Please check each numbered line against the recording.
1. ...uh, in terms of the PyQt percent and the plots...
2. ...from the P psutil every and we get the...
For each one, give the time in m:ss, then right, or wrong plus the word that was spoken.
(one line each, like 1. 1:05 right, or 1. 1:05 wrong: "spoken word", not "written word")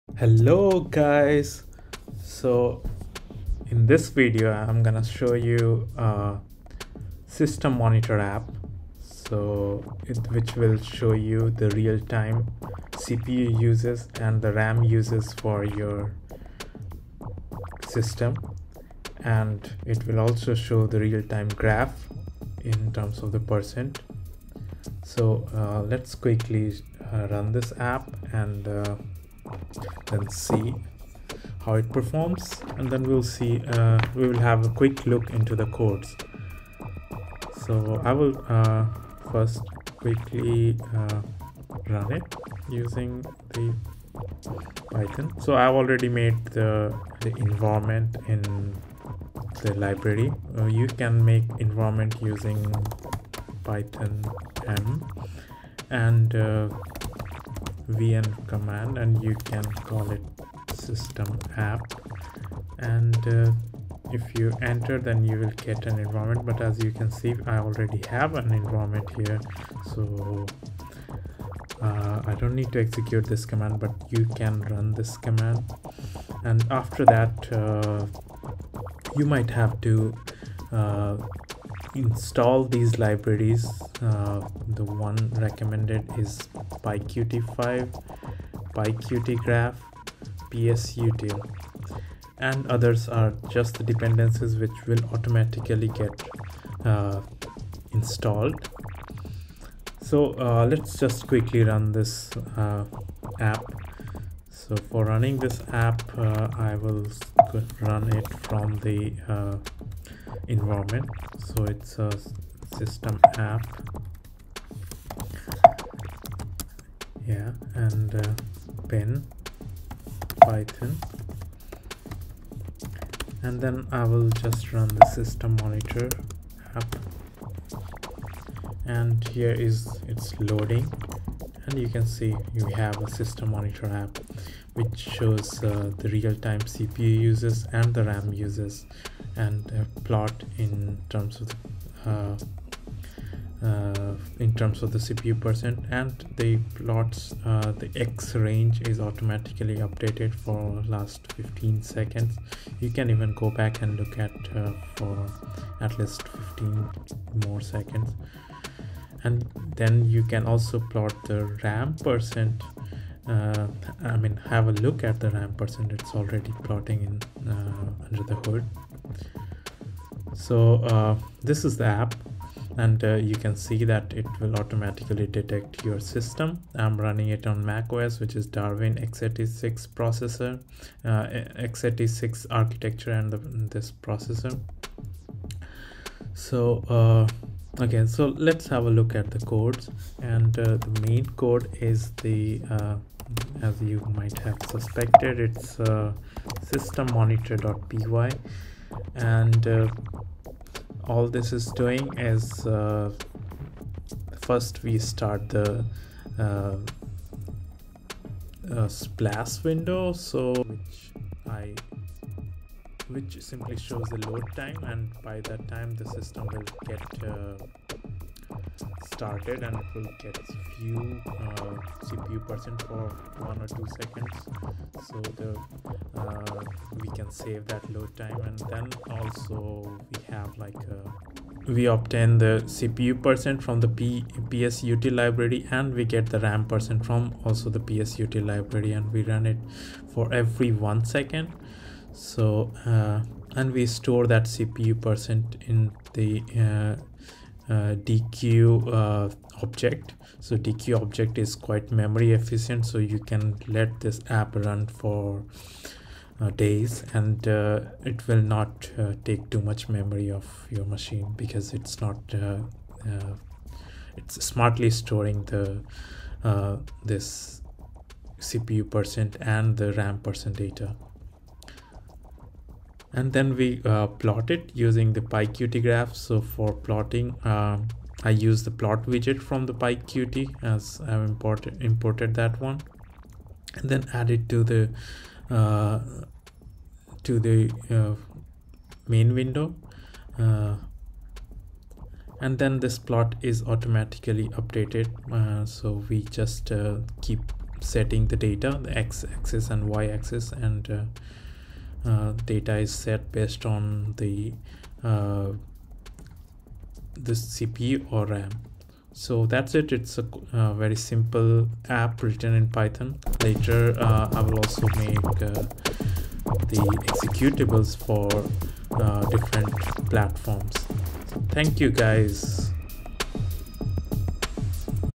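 1. 2:23 wrong: "CPU", not "PyQt"
2. 3:53 wrong: "library", not "every".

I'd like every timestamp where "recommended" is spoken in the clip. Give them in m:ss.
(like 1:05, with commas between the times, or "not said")
1:25.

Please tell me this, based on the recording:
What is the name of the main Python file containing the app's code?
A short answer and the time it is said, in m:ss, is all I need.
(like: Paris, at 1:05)
system monitor.py, at 3:16.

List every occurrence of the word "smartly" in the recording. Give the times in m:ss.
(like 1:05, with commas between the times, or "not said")
4:24.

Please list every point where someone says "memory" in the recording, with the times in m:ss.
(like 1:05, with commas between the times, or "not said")
4:11, 4:19.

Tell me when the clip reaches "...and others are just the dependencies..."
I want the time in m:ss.
1:32.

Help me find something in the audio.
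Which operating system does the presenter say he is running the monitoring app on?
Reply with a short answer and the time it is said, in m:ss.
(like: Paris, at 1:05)
macOS, at 2:57.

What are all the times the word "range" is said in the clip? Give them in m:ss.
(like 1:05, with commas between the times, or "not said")
2:28.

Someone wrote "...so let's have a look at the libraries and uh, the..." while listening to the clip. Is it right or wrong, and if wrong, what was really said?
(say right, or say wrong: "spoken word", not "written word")
wrong: "codes", not "libraries".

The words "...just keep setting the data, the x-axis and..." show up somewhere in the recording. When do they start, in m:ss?
4:56.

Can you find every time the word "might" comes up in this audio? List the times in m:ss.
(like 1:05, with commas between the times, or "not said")
1:19, 3:14.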